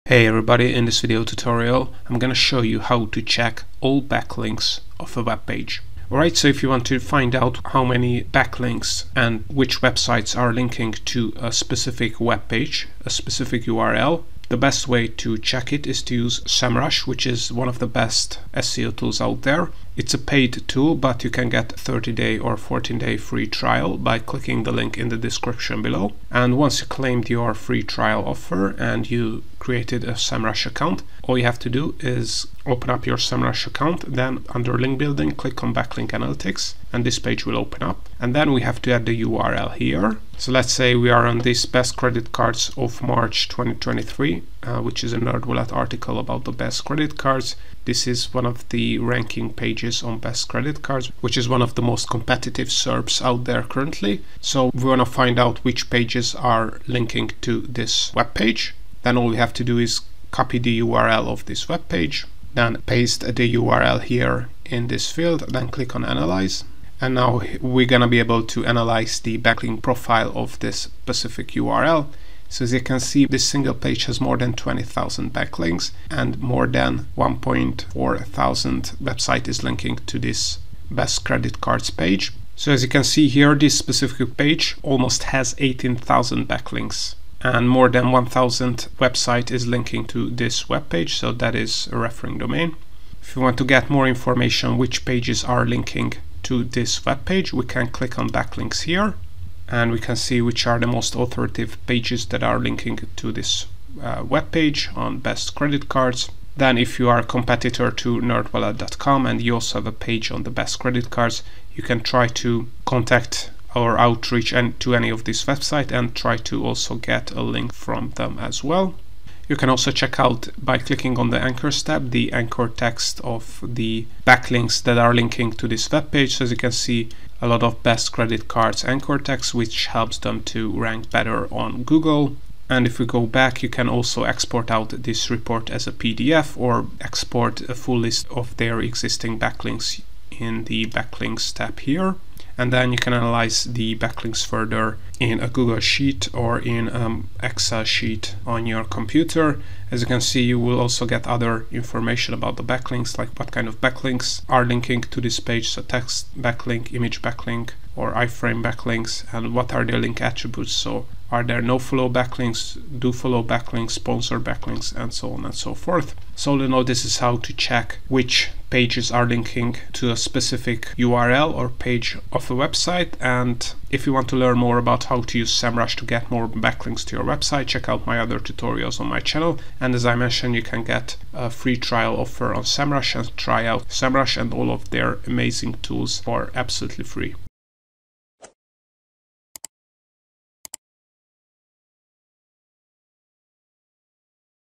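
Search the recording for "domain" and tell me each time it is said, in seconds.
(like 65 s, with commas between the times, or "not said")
92 s.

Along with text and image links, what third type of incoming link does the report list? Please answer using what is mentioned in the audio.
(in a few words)
iframe.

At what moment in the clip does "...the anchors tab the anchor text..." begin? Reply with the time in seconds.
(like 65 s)
121 s.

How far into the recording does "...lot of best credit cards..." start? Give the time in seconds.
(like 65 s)
127 s.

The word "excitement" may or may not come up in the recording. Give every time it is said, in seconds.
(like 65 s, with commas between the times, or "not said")
not said.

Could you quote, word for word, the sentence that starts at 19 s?
It's a paid tool, but you can get 30-day or 14-day free trial by clicking the link in the description below.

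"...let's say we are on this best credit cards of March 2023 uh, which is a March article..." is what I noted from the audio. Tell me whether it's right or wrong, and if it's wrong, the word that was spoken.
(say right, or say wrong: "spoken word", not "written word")
wrong: "NerdWallet", not "March".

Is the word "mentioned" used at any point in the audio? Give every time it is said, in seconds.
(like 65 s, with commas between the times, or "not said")
180 s.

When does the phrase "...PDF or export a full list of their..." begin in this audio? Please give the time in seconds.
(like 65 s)
135 s.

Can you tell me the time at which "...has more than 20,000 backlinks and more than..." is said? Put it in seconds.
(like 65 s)
74 s.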